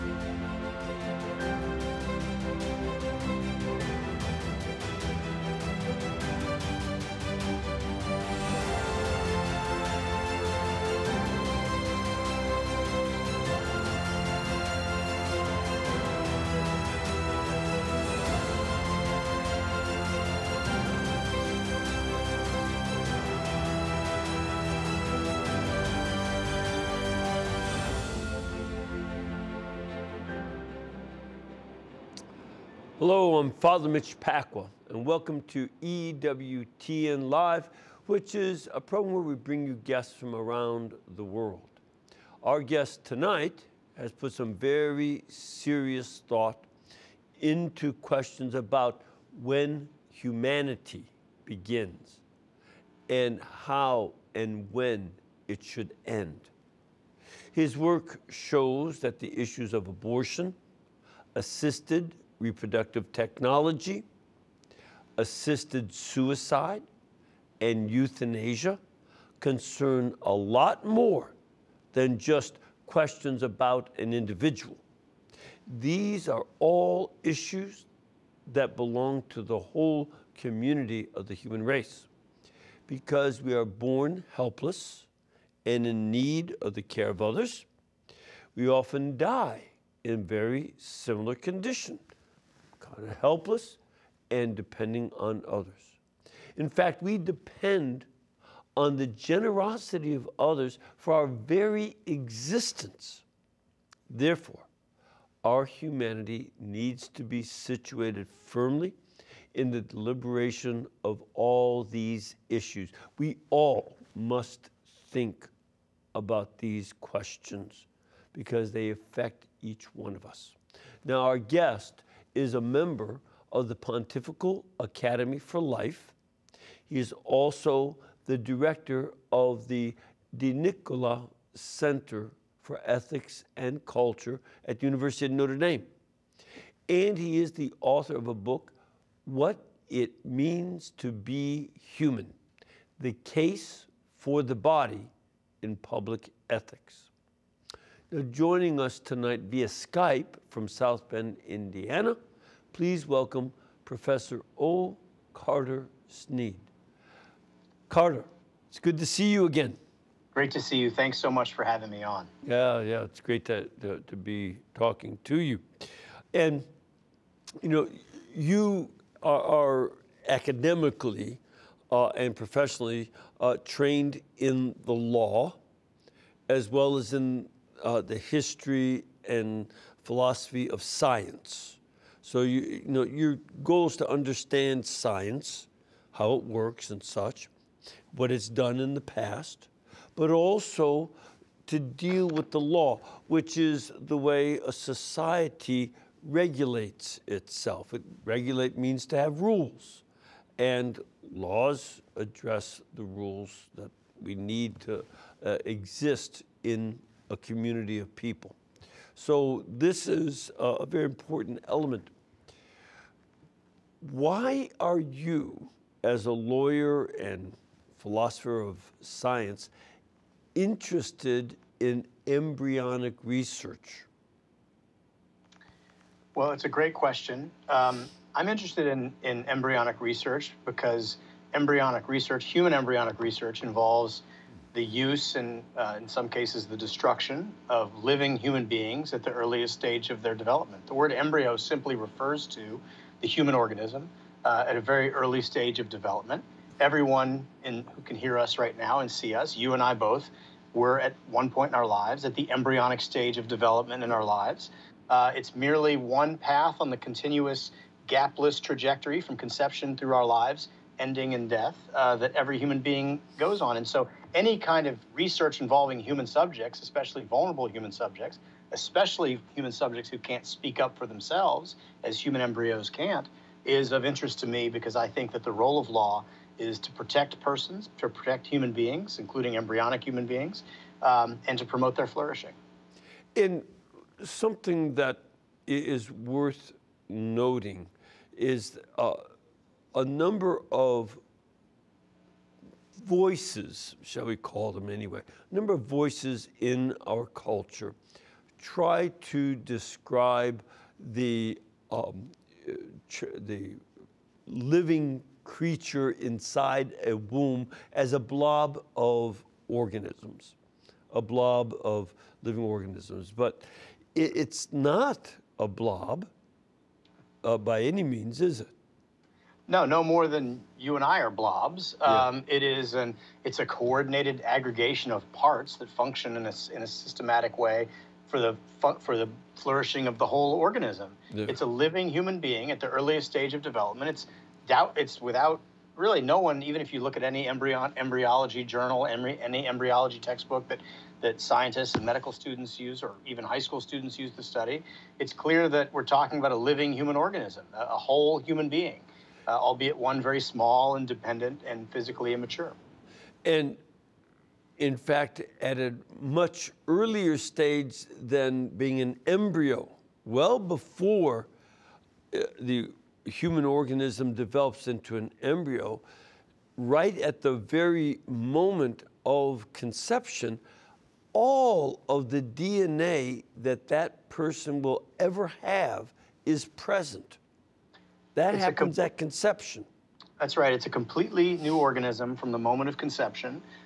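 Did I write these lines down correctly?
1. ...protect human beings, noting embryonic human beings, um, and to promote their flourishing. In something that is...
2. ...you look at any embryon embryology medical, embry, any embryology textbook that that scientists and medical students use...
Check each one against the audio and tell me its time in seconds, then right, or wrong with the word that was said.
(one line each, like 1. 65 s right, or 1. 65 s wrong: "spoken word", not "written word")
1. 278 s wrong: "including", not "noting"
2. 336 s wrong: "journal", not "medical".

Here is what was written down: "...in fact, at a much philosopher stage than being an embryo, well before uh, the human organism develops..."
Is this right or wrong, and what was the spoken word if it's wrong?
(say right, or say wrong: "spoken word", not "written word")
wrong: "earlier", not "philosopher".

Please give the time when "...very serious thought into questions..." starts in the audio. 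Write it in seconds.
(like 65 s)
44 s.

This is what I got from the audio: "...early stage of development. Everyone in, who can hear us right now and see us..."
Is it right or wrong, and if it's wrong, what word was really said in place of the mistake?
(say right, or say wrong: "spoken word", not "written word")
right.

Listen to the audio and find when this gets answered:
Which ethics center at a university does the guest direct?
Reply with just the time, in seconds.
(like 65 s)
130 s.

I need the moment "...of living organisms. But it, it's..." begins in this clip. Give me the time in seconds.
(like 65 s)
311 s.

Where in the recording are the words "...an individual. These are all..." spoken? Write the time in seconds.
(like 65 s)
73 s.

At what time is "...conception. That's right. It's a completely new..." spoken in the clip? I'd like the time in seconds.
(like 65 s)
379 s.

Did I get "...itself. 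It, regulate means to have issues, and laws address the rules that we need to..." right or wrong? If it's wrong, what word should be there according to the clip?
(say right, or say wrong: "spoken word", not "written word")
wrong: "rules", not "issues".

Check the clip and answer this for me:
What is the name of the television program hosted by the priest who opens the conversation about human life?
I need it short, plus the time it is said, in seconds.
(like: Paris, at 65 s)
EWTN Live, at 35 s.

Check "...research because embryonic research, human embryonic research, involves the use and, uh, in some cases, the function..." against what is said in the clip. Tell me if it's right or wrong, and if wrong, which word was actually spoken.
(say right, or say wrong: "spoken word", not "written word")
wrong: "destruction", not "function".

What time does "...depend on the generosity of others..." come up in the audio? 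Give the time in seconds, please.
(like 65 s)
97 s.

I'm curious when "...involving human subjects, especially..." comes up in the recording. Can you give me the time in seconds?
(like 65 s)
265 s.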